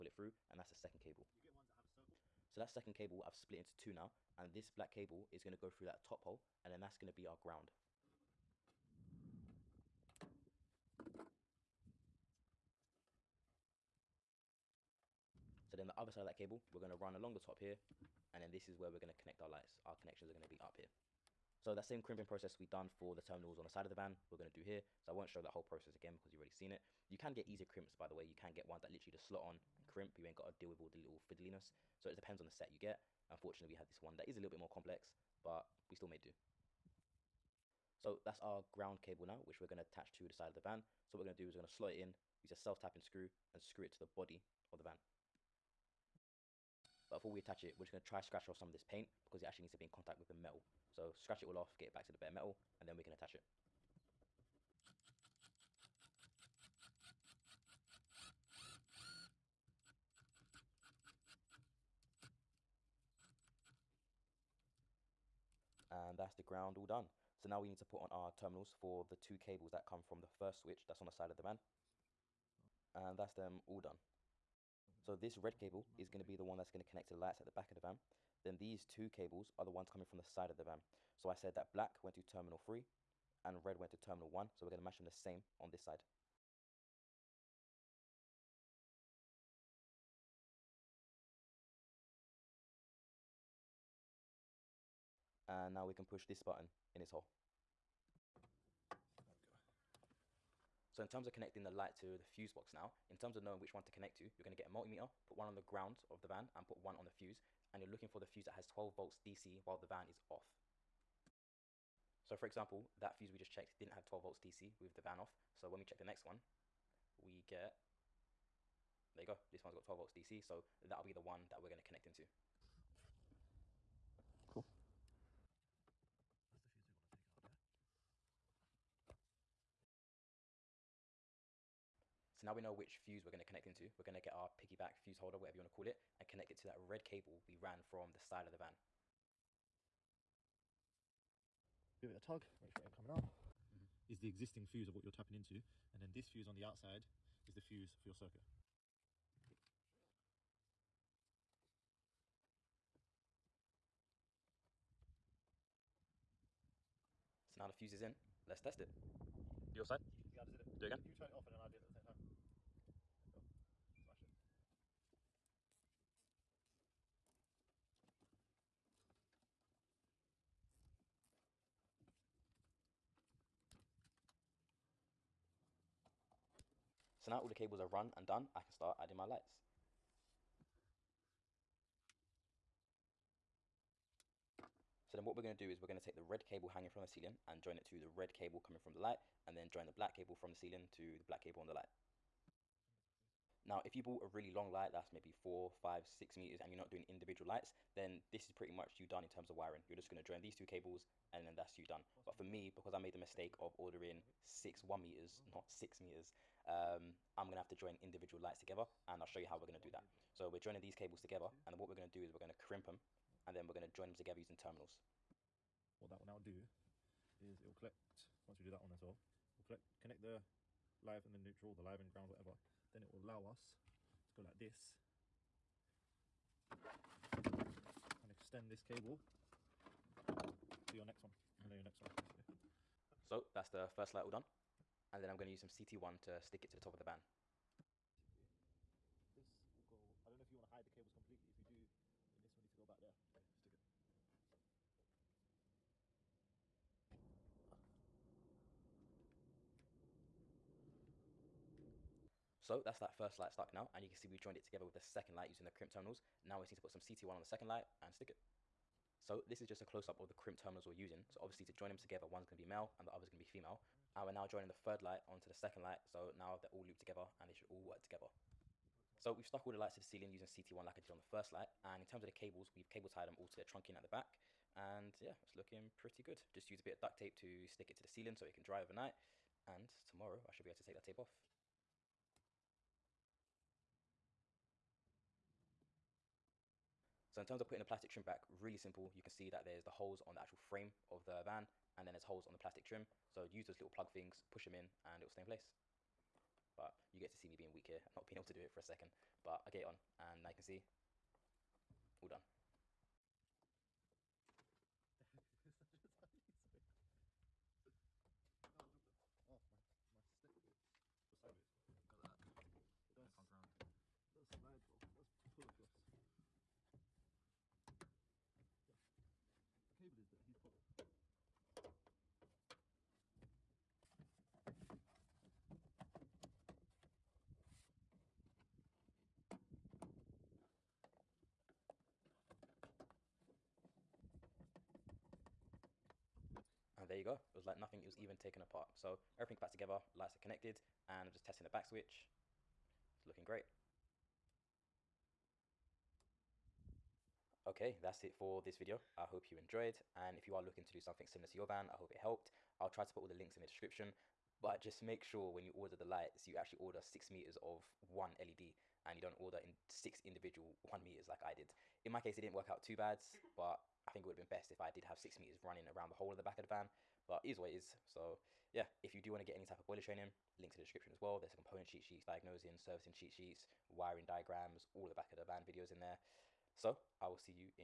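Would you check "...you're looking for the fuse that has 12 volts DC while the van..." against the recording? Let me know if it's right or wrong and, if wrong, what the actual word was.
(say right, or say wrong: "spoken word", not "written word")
right.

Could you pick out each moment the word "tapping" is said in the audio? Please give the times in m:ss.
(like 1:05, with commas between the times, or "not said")
0:42, 2:25.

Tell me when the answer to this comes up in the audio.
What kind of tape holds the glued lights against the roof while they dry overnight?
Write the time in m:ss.
4:37.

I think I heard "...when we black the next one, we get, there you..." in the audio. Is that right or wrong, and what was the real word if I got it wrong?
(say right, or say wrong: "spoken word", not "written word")
wrong: "check", not "black".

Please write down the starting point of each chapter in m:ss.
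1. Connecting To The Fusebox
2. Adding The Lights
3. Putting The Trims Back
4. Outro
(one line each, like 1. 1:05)
1. 1:40
2. 2:56
3. 4:47
4. 5:47.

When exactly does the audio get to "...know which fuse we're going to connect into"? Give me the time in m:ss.
2:12.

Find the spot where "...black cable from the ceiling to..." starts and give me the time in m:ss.
3:09.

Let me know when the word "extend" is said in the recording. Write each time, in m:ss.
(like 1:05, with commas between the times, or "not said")
3:48.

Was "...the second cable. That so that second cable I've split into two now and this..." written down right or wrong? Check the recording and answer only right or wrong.
right.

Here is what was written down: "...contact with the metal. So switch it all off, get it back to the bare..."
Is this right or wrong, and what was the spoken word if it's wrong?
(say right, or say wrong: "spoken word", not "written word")
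wrong: "scratch", not "switch".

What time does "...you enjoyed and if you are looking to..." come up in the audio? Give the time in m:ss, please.
5:49.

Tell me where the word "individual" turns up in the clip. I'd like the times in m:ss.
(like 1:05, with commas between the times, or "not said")
3:17, 3:28, 6:00.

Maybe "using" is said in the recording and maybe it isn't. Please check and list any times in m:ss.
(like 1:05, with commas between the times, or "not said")
3:34, 4:15, 4:20, 4:30.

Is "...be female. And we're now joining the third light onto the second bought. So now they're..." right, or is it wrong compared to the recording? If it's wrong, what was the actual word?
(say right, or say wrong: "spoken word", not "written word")
wrong: "light", not "bought".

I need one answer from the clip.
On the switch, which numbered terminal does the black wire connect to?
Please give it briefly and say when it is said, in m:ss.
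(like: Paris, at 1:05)
3, at 1:22.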